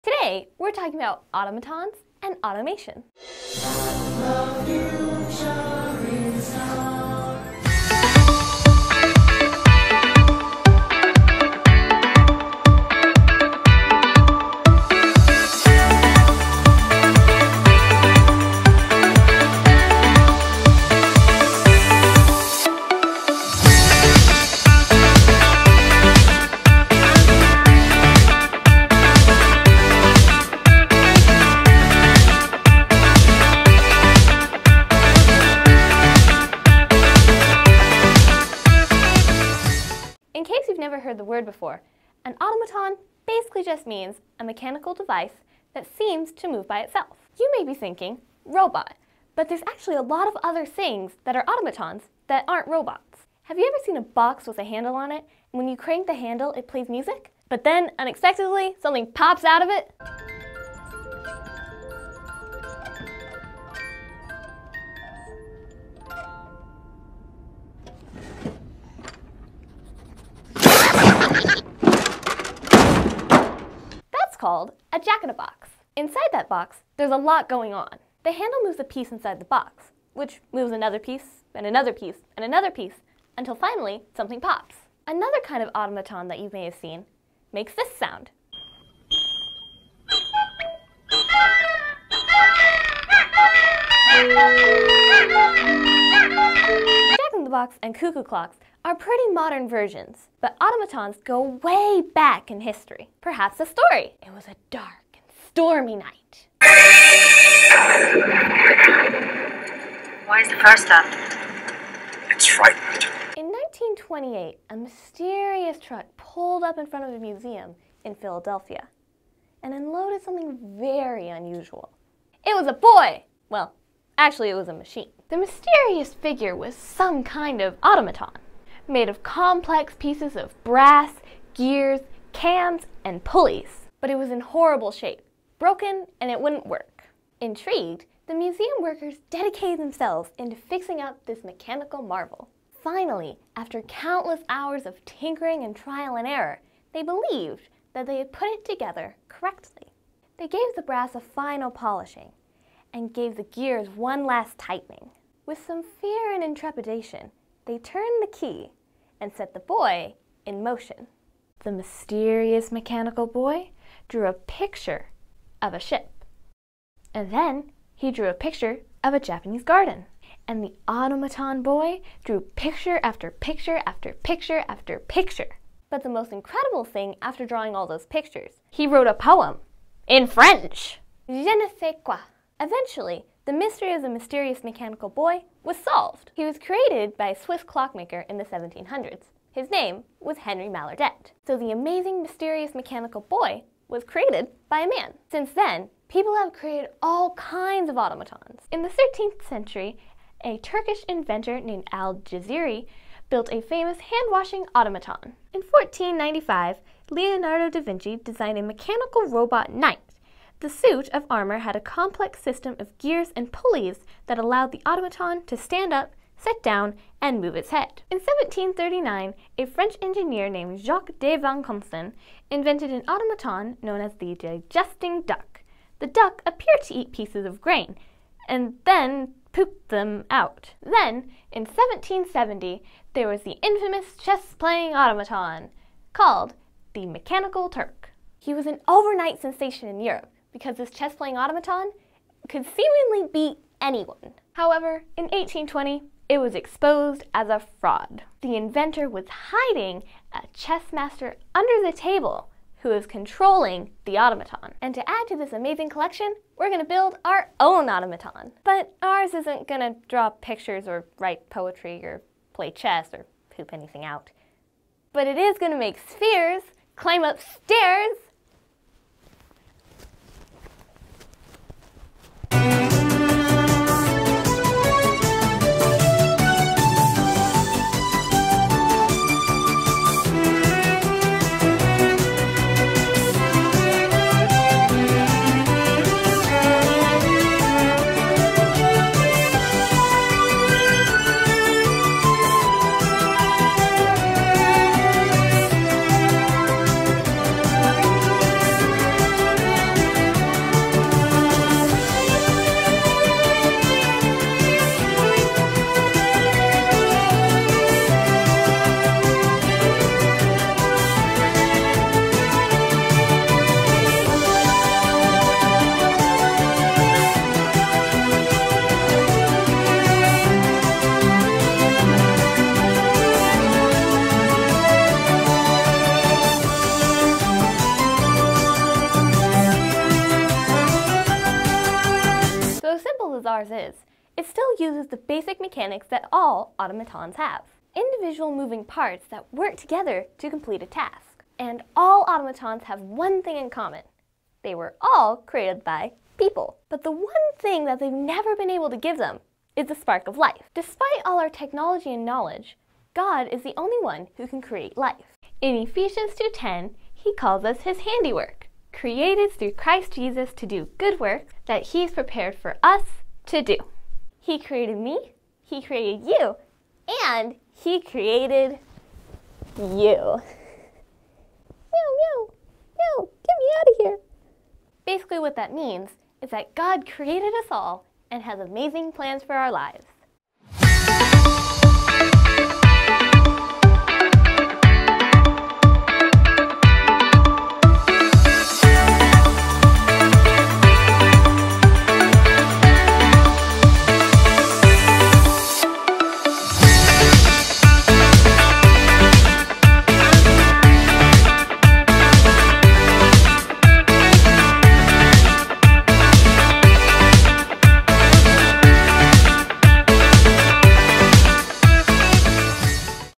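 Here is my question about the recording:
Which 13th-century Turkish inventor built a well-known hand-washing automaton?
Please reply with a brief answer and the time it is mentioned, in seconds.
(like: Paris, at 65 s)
Al-Jaziri, at 201 s.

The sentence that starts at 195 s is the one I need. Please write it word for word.
Since then, people have created all kinds of automatons.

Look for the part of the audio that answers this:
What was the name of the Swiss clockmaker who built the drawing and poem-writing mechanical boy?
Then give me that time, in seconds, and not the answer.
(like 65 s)
190 s.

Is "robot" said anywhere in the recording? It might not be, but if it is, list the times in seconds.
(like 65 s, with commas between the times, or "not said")
48 s, 52 s, 209 s.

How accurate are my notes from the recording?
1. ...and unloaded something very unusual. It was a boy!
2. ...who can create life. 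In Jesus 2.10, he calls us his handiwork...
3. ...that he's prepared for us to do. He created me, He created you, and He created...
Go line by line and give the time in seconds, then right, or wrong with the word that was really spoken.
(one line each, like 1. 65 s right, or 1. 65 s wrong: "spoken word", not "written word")
1. 119 s right
2. 354 s wrong: "Ephesians", not "Jesus"
3. 361 s right.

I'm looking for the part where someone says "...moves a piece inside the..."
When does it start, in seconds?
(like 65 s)
78 s.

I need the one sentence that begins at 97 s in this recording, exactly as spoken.
Jack-in-the-Box and cuckoo clocks are pretty modern versions, but automatons go way back in history.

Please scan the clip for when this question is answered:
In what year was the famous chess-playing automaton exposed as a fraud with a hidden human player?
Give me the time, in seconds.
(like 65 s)
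245 s.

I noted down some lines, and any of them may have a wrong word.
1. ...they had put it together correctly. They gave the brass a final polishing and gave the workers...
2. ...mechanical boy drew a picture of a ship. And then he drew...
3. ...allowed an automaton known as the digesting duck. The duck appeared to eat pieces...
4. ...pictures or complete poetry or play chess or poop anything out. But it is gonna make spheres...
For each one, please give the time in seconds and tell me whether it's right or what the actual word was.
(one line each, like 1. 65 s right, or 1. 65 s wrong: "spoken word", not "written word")
1. 148 s wrong: "gears", not "workers"
2. 162 s right
3. 222 s wrong: "invented", not "allowed"
4. 260 s wrong: "write", not "complete".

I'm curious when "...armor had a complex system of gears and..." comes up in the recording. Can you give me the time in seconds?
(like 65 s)
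211 s.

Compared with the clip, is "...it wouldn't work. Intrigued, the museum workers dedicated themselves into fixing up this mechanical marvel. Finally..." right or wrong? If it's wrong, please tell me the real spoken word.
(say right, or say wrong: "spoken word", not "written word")
right.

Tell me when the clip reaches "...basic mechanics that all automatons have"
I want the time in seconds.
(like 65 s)
335 s.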